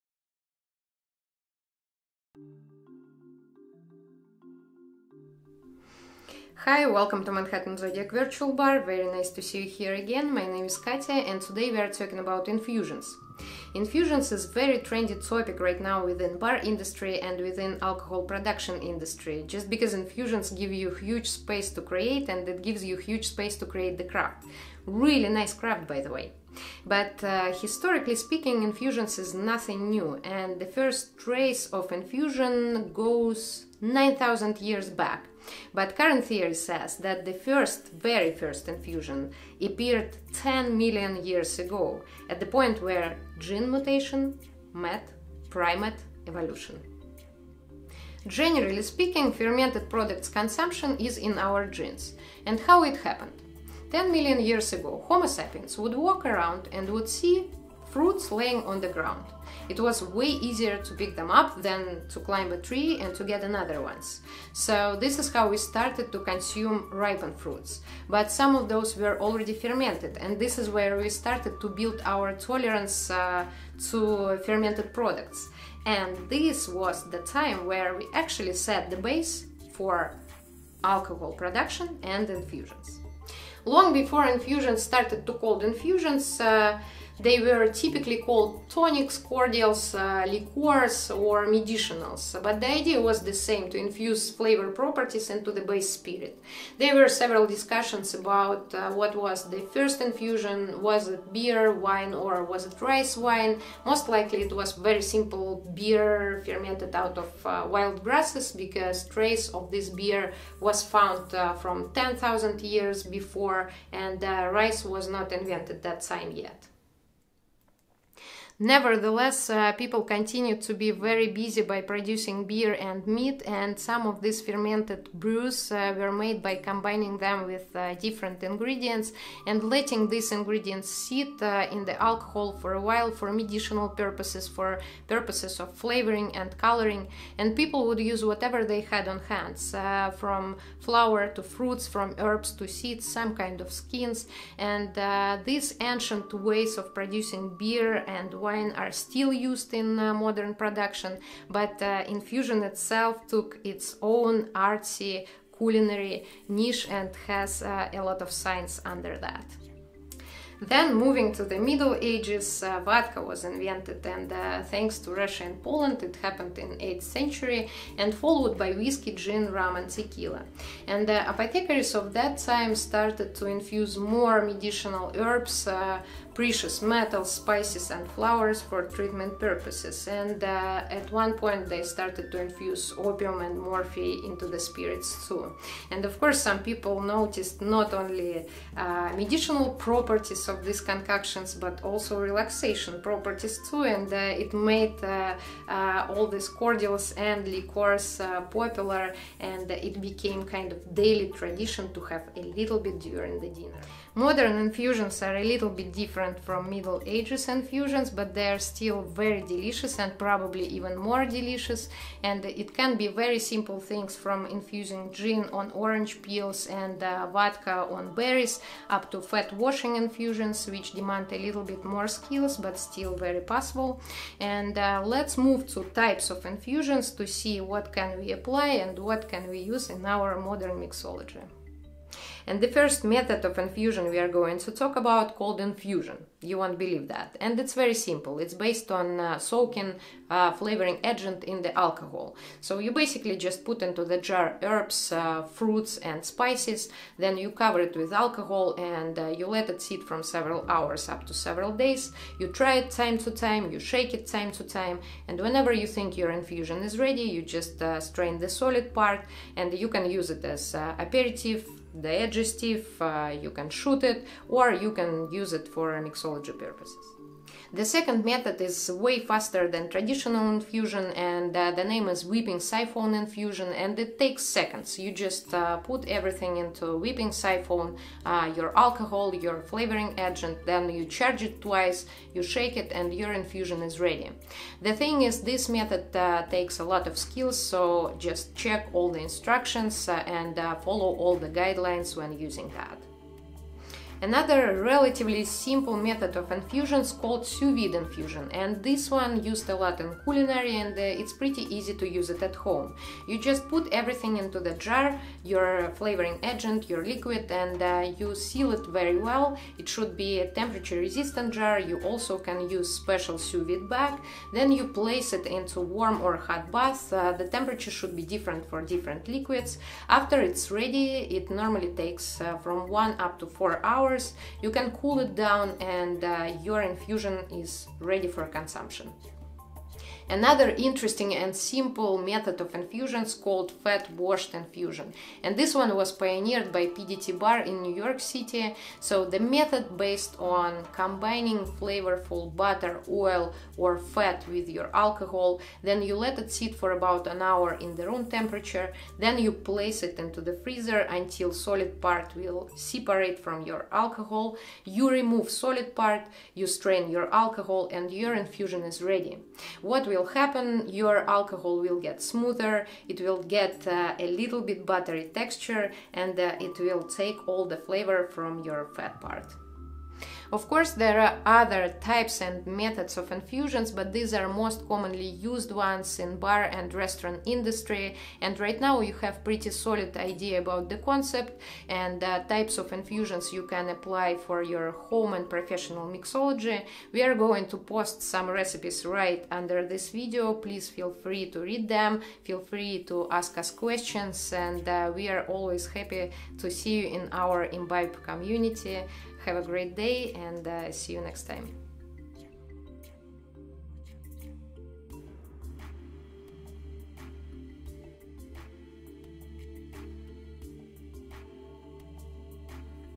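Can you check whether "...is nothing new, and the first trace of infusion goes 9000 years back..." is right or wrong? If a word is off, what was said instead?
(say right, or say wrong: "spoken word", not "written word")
right.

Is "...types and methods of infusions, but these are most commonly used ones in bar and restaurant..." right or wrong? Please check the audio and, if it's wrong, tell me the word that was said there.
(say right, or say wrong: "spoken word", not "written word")
right.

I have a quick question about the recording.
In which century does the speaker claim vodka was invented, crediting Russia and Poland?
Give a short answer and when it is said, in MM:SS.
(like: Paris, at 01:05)
8th century, at 02:46.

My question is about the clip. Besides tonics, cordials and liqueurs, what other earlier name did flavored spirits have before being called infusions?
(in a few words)
medicinals.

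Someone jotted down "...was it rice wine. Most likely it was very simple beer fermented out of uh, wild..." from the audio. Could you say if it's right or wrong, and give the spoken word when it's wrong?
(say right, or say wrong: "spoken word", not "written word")
right.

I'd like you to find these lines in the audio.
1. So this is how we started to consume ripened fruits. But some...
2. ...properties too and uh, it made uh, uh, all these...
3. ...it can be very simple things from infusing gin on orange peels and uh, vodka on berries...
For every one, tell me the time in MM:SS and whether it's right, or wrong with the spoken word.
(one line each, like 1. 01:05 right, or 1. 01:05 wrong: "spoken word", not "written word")
1. 01:04 right
2. 03:13 right
3. 03:32 right.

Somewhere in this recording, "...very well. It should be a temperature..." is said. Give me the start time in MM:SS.
05:08.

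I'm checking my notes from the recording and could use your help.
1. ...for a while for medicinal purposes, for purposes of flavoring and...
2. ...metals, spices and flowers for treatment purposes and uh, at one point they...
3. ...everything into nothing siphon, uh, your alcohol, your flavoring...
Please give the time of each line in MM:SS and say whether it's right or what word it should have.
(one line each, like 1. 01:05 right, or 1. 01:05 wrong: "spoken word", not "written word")
1. 02:12 right
2. 02:56 right
3. 04:36 wrong: "whipping", not "nothing".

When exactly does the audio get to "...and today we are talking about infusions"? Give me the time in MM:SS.
00:11.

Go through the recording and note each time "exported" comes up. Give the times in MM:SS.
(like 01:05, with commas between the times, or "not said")
not said.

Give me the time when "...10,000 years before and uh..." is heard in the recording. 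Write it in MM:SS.
01:51.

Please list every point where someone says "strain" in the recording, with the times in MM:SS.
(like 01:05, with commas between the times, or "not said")
04:17, 05:56.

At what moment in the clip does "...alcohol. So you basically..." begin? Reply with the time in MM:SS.
04:01.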